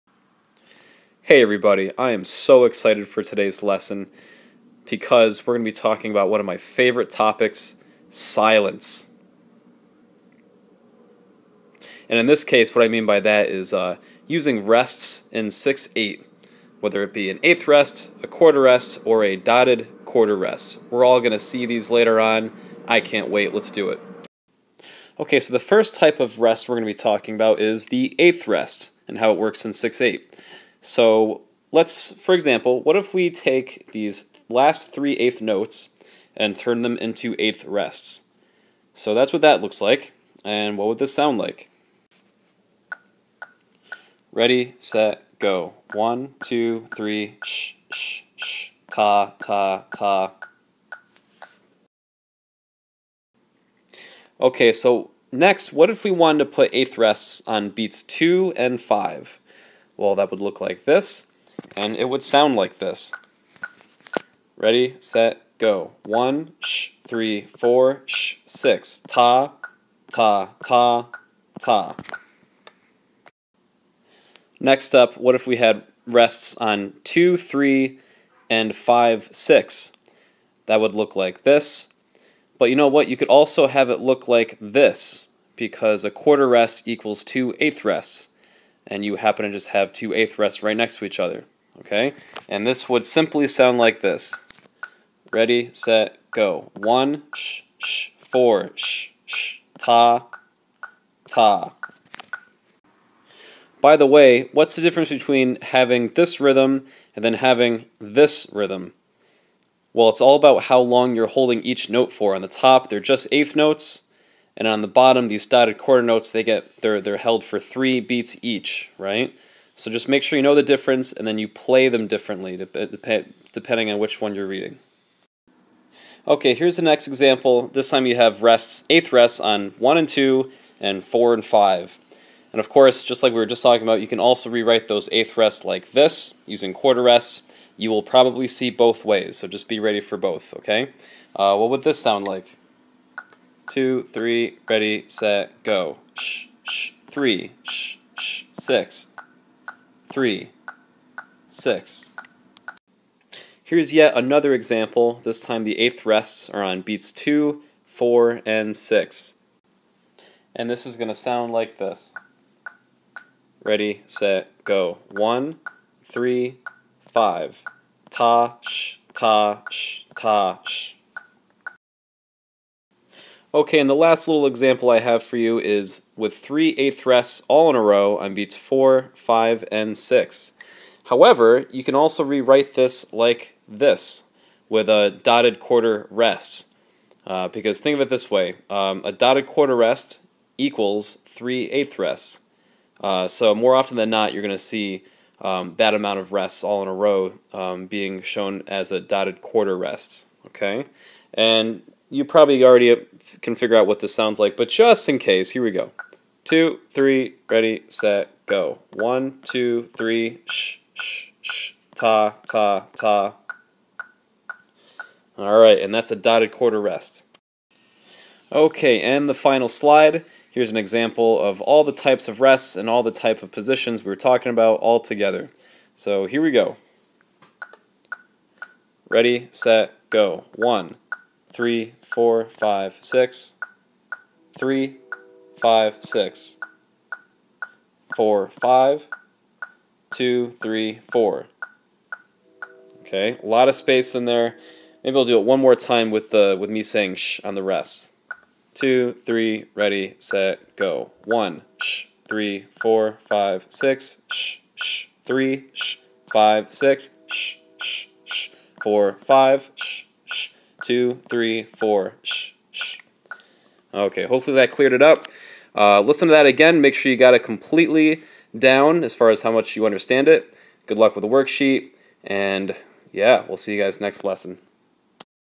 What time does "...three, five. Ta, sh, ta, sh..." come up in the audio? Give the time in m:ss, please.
2:46.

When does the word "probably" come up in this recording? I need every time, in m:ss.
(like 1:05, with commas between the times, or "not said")
2:18, 3:22.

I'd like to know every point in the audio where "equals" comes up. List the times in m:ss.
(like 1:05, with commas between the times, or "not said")
1:26, 3:10.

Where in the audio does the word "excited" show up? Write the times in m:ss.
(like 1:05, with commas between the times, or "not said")
0:02.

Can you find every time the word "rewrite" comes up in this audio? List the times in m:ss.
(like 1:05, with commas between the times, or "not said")
2:14, 3:02.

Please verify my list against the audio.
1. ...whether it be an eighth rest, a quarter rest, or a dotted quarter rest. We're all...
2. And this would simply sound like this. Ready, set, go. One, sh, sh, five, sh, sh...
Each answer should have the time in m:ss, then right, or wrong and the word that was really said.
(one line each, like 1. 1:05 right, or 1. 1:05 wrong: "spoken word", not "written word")
1. 0:16 right
2. 1:32 wrong: "four", not "five".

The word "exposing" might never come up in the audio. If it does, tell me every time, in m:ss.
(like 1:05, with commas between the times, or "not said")
not said.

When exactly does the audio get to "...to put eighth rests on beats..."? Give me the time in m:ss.
0:56.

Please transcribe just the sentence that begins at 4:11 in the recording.
One, shh, three, four, five, six, shh, shh, three, shh, five, six, shh, shh, shh, four, five, shh two, three, four.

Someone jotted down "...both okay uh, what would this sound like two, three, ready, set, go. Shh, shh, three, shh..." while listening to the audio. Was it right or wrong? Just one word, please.
right.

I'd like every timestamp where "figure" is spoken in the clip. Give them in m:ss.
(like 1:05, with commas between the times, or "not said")
3:23.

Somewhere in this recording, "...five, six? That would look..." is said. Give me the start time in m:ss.
1:18.